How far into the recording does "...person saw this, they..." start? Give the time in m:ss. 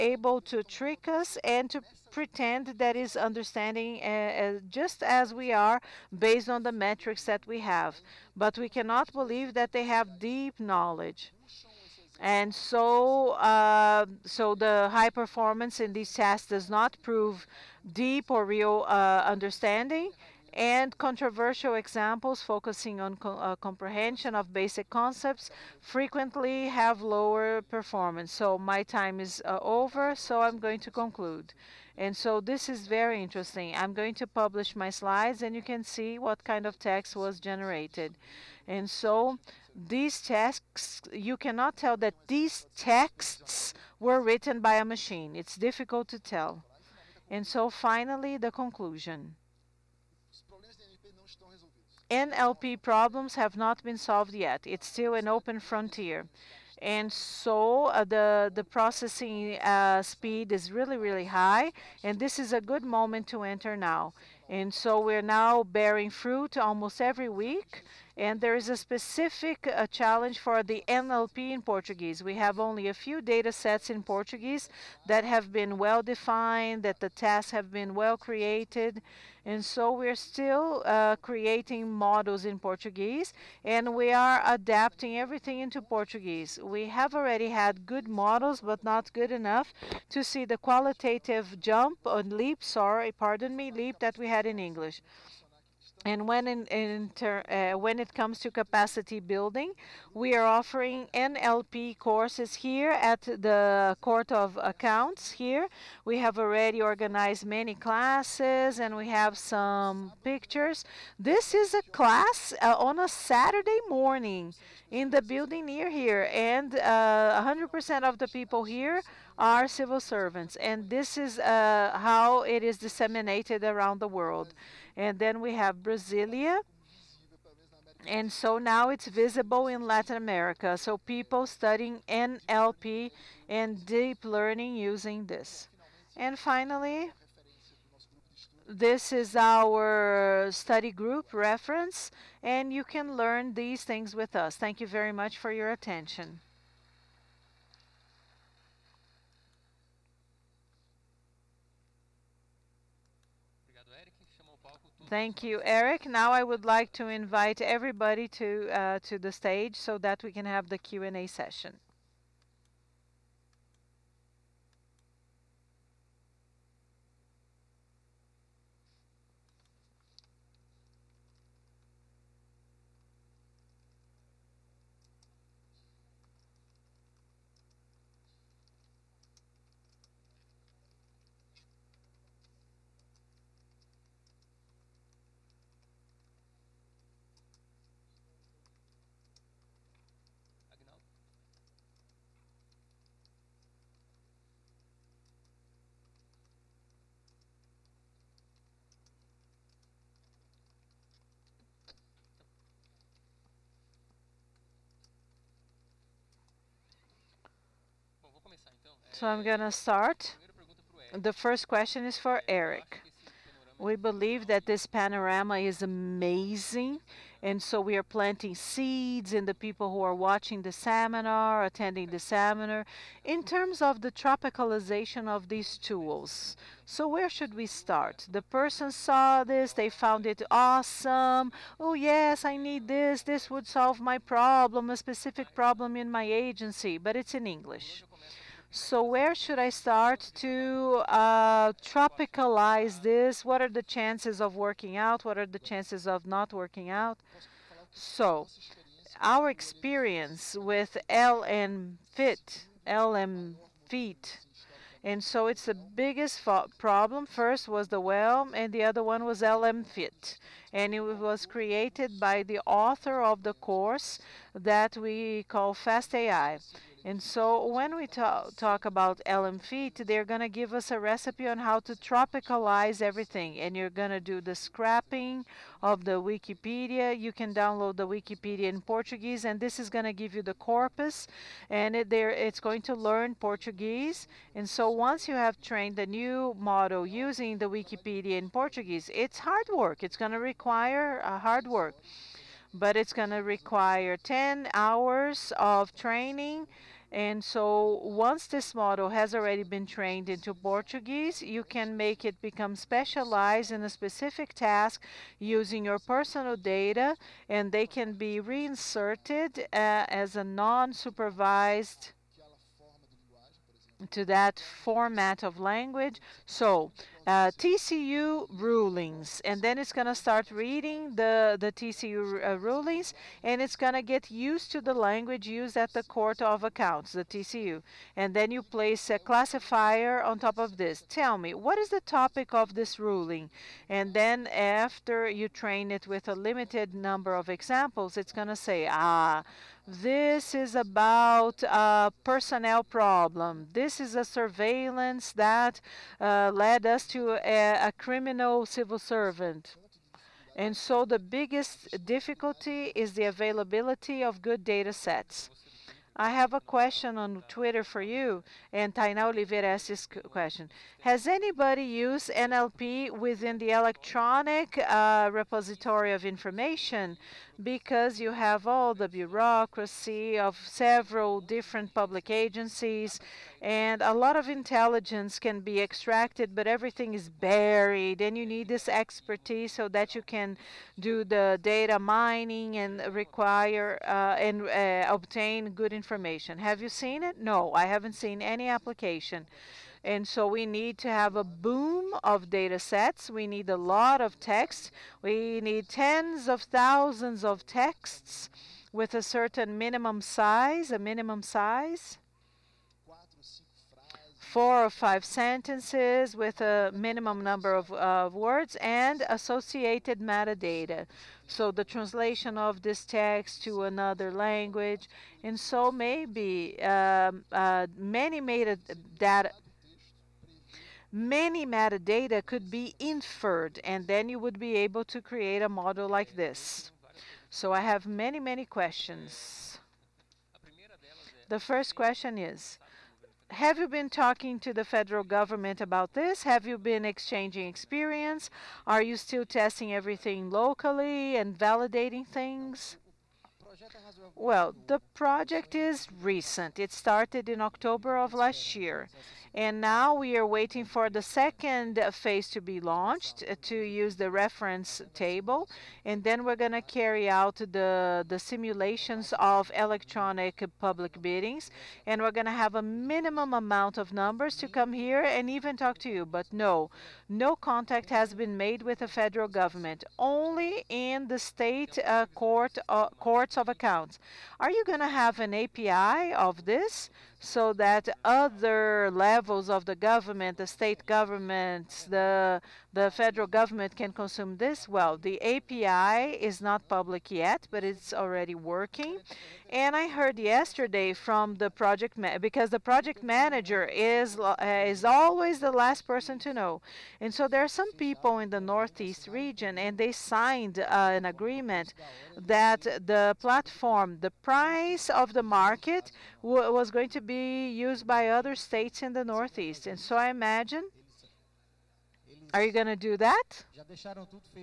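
3:48.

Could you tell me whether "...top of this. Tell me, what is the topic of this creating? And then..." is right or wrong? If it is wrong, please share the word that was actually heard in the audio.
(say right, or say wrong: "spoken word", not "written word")
wrong: "ruling", not "creating".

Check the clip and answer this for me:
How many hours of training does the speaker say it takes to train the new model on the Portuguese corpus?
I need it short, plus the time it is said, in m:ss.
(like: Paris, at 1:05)
10 hours, at 4:54.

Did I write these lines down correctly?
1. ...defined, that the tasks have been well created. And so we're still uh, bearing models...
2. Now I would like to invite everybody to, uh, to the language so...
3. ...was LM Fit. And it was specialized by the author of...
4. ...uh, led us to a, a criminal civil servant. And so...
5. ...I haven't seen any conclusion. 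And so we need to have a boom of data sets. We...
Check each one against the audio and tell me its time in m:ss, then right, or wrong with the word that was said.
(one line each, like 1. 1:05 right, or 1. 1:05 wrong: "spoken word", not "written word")
1. 1:16 wrong: "creating", not "bearing"
2. 2:36 wrong: "stage", not "language"
3. 4:19 wrong: "created", not "specialized"
4. 5:46 right
5. 6:27 wrong: "application", not "conclusion".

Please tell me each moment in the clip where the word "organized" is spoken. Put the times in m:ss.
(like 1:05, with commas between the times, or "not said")
1:46.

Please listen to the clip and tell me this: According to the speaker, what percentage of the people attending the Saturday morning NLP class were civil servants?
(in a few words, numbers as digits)
100%.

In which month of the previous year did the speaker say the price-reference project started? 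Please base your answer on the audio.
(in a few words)
October.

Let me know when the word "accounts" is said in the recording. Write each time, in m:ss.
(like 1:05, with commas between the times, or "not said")
1:44, 5:26, 7:53.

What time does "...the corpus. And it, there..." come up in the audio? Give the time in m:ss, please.
4:40.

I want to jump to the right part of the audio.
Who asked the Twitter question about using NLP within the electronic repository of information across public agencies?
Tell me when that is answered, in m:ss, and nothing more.
5:58.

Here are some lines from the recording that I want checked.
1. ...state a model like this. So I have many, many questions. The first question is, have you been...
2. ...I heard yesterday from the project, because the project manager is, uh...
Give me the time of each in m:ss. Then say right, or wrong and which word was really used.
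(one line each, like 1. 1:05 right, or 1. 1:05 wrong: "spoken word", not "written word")
1. 7:05 wrong: "create", not "state"
2. 8:09 right.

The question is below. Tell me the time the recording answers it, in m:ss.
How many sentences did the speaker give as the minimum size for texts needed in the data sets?
6:44.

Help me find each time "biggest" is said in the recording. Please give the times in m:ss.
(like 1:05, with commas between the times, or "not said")
4:15, 5:51.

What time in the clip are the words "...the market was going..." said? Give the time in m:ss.
8:25.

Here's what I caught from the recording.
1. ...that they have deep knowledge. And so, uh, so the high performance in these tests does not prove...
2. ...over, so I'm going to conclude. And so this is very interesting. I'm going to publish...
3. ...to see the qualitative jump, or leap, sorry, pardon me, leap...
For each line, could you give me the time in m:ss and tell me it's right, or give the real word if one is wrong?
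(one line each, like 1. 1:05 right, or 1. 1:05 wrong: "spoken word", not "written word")
1. 0:09 right
2. 0:29 right
3. 1:30 right.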